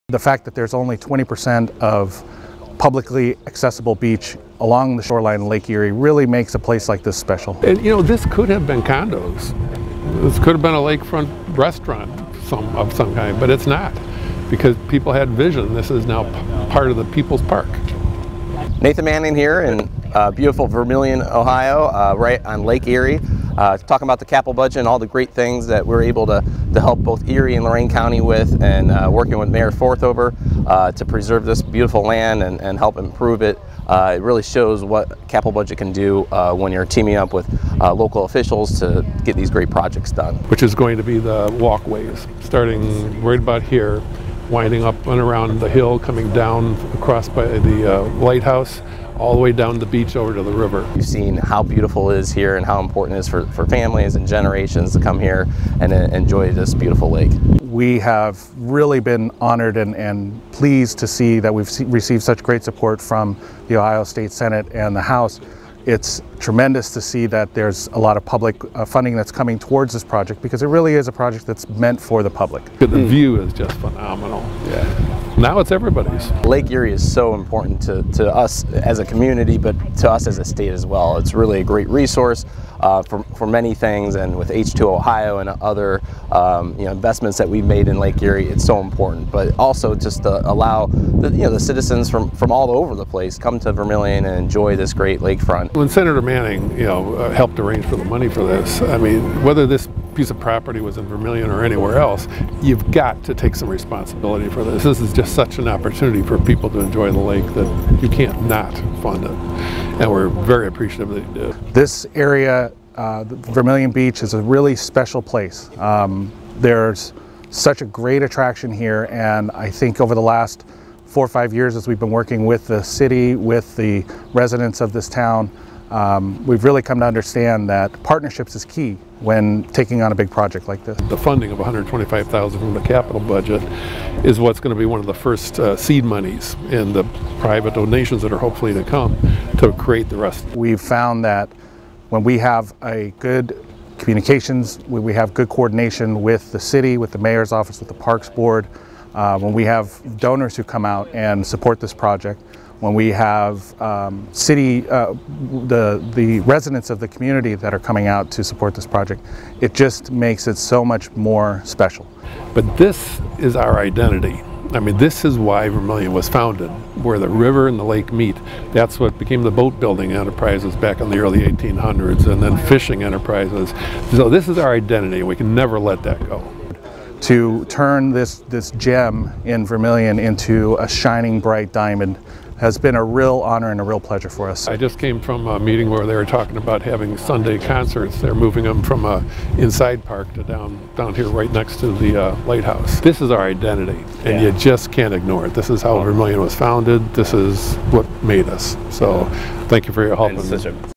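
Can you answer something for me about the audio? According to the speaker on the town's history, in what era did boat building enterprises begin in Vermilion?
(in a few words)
early 1800s.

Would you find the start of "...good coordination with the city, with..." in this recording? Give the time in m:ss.
2:25.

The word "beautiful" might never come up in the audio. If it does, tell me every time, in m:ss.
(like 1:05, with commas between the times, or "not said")
0:20, 0:31, 0:51, 0:56.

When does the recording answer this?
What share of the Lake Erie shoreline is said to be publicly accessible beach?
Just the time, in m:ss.
0:00.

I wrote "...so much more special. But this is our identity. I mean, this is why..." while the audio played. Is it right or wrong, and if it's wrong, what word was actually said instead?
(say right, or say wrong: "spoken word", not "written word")
right.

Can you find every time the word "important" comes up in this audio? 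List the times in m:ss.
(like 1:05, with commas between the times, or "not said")
0:52, 1:17, 1:28.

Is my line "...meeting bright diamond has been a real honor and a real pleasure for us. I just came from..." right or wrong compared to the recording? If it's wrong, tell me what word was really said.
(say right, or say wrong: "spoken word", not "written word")
wrong: "shining", not "meeting".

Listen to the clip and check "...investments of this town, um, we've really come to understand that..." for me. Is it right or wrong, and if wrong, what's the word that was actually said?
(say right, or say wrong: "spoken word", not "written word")
wrong: "residents", not "investments".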